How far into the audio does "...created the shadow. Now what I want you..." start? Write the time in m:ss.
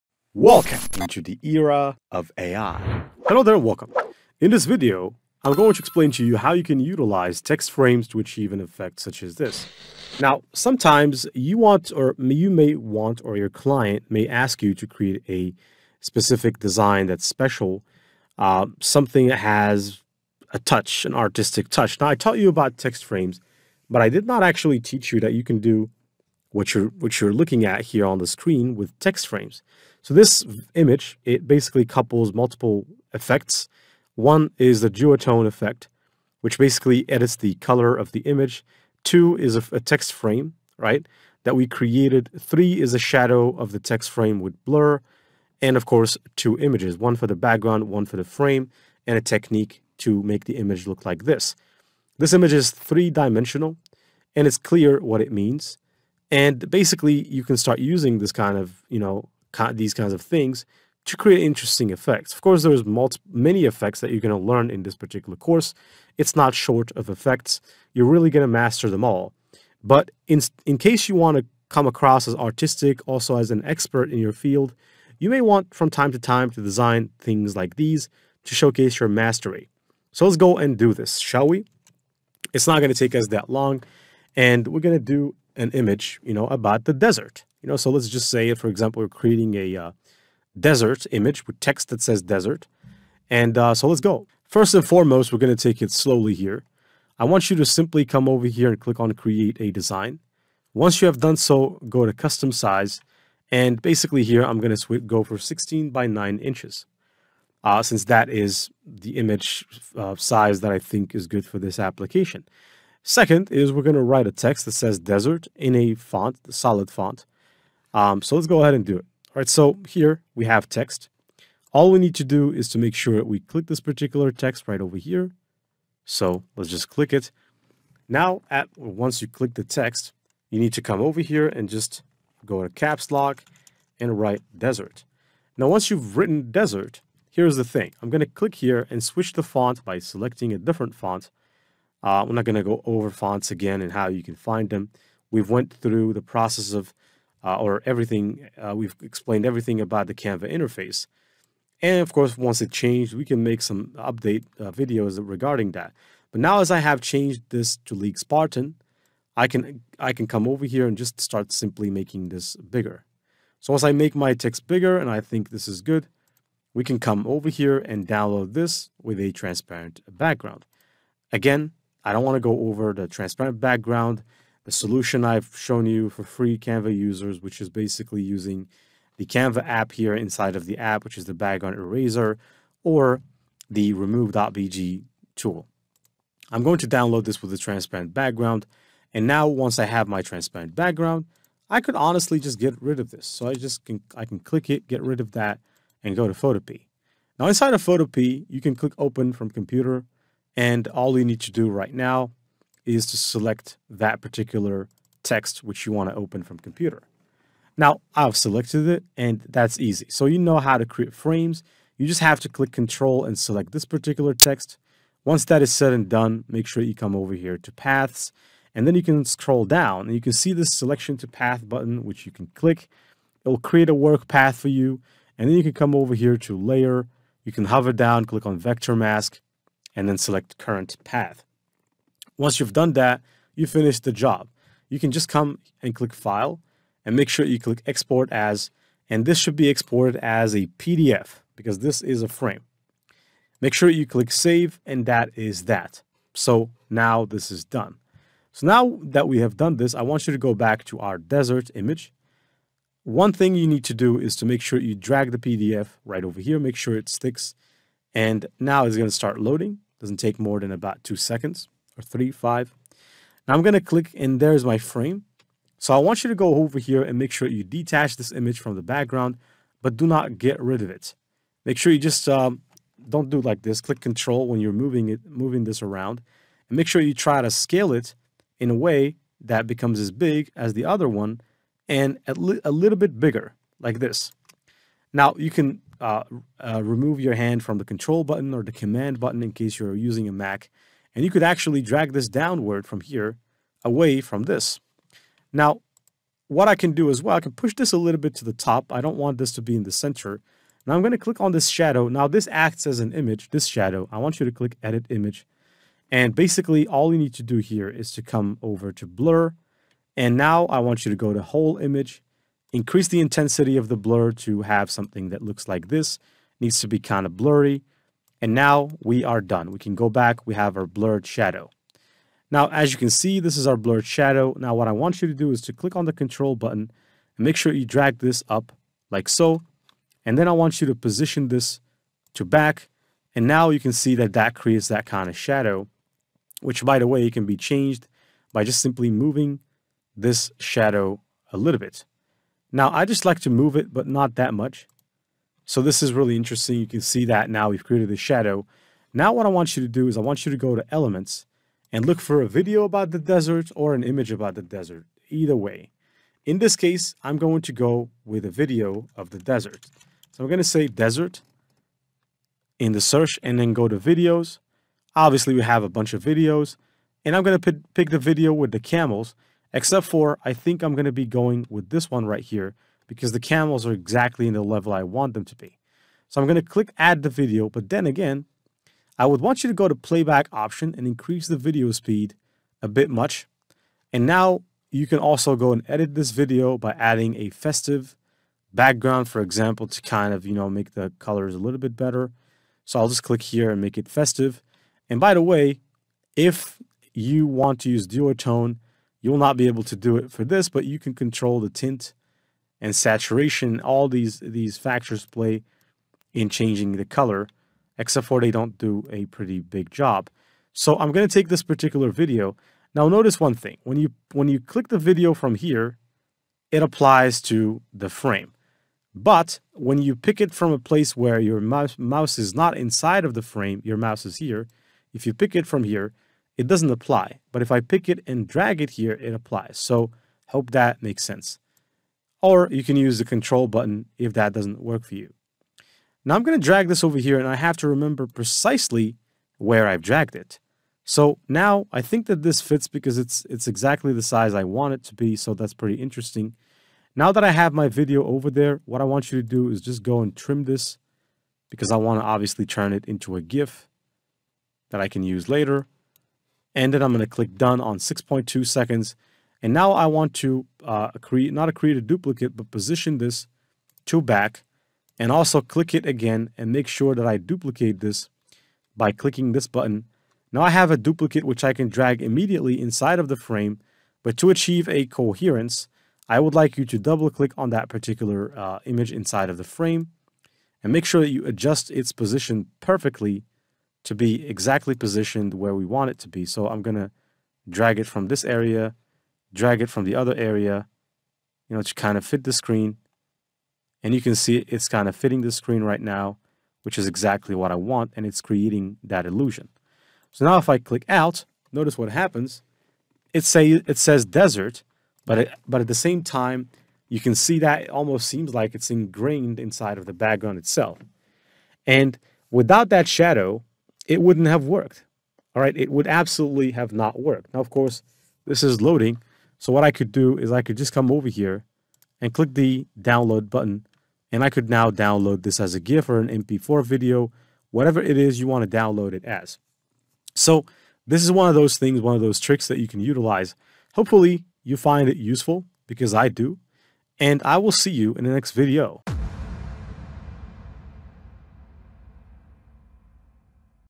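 5:47.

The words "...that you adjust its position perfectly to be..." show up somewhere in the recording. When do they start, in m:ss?
8:01.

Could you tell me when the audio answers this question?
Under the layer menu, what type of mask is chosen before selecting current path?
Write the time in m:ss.
3:48.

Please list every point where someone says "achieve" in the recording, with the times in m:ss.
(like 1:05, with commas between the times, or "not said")
0:08, 7:54.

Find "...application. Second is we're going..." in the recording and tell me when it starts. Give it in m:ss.
1:51.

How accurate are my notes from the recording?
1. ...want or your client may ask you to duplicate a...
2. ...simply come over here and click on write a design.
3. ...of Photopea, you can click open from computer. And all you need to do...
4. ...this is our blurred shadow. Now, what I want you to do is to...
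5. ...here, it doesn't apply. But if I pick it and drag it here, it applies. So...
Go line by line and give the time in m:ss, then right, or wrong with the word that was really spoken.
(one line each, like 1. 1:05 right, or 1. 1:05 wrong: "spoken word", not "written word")
1. 0:12 wrong: "create", not "duplicate"
2. 1:37 wrong: "create", not "write"
3. 3:17 right
4. 5:23 right
5. 7:05 right.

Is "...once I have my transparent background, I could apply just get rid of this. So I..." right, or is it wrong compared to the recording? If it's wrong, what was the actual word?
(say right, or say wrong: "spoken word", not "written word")
wrong: "honestly", not "apply".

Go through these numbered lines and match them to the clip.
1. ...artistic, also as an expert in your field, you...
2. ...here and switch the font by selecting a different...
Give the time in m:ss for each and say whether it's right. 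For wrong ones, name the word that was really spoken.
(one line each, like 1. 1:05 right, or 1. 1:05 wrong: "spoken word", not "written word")
1. 1:12 right
2. 2:18 right.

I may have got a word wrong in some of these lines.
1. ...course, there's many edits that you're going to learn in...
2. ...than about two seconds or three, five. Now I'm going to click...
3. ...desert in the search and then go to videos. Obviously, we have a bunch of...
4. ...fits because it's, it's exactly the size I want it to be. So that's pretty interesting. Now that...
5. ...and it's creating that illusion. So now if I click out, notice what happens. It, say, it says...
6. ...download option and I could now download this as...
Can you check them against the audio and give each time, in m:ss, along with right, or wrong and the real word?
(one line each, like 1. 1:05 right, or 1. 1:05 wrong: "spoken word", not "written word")
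1. 1:02 wrong: "effects", not "edits"
2. 4:20 right
3. 6:00 right
4. 7:22 right
5. 8:18 right
6. 8:42 wrong: "button", not "option".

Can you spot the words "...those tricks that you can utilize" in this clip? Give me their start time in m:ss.
8:52.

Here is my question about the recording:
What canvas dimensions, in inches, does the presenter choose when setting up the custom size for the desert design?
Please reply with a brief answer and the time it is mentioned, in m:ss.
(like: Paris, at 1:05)
16 by 9 inches, at 1:45.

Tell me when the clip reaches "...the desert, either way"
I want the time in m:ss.
5:54.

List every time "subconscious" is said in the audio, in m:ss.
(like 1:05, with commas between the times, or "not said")
not said.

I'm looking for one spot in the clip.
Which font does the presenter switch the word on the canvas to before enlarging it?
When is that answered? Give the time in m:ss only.
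2:37.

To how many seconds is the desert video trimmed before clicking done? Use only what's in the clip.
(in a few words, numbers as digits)
6.2 seconds.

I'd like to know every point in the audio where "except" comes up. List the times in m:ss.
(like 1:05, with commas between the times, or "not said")
6:09, 6:47.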